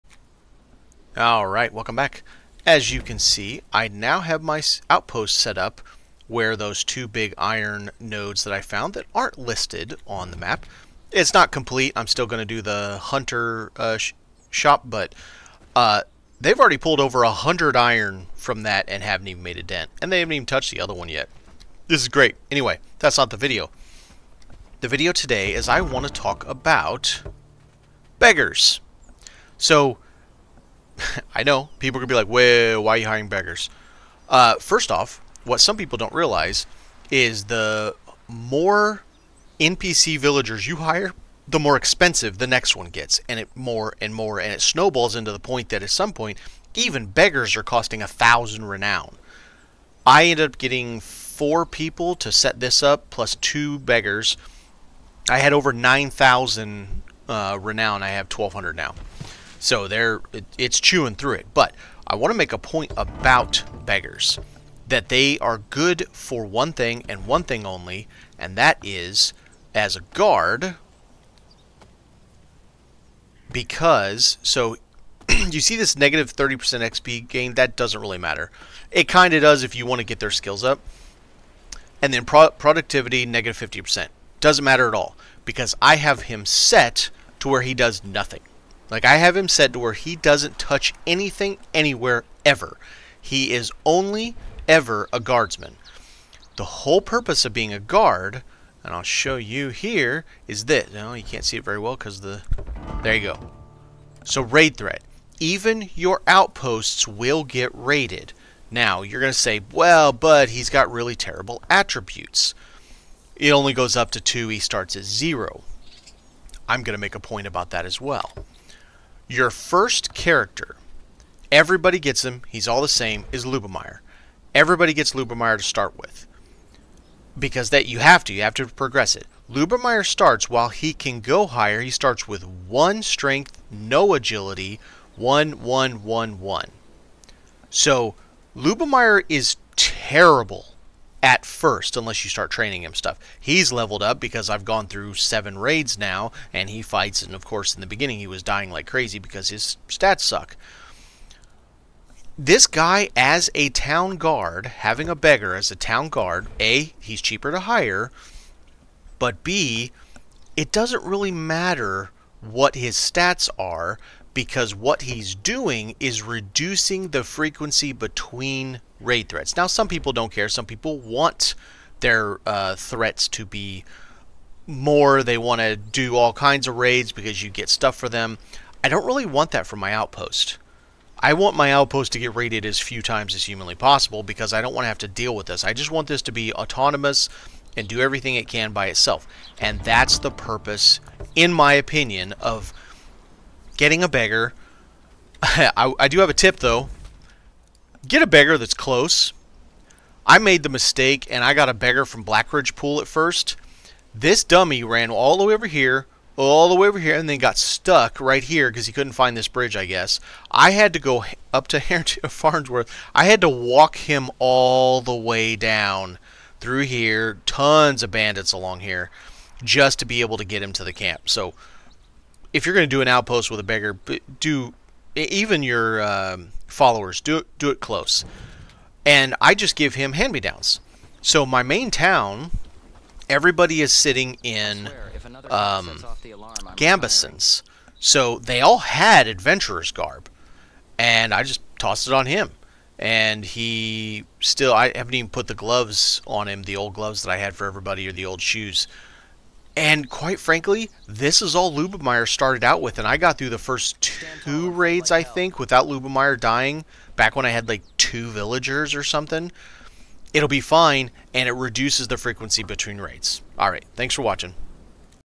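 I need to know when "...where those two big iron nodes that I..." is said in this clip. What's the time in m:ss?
0:06.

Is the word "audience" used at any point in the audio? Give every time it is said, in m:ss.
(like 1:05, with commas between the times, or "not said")
not said.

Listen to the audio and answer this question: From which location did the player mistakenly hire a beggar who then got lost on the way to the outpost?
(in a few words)
Blackridge Pool.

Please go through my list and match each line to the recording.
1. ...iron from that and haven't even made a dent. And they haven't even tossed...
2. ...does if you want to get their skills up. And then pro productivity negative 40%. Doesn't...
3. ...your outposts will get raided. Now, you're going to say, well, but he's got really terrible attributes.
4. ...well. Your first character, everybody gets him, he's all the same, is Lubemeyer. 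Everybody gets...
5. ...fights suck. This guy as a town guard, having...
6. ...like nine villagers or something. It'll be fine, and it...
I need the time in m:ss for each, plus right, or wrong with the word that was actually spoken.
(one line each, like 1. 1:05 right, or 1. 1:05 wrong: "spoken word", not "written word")
1. 0:17 wrong: "touched", not "tossed"
2. 1:19 wrong: "50", not "40"
3. 1:45 right
4. 1:58 right
5. 2:29 wrong: "stats", not "fights"
6. 4:17 wrong: "two", not "nine".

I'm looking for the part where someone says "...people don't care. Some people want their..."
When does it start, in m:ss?
2:49.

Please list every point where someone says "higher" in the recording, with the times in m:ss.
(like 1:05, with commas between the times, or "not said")
2:11.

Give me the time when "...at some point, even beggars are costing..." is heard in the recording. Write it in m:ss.
0:45.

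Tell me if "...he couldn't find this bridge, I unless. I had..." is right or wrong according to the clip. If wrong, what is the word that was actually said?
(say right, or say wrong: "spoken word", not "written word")
wrong: "guess", not "unless".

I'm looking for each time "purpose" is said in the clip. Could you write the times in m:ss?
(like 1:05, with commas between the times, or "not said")
1:36, 3:10.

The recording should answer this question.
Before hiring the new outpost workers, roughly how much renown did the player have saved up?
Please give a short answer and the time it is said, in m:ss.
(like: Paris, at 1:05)
over 9,000, at 0:55.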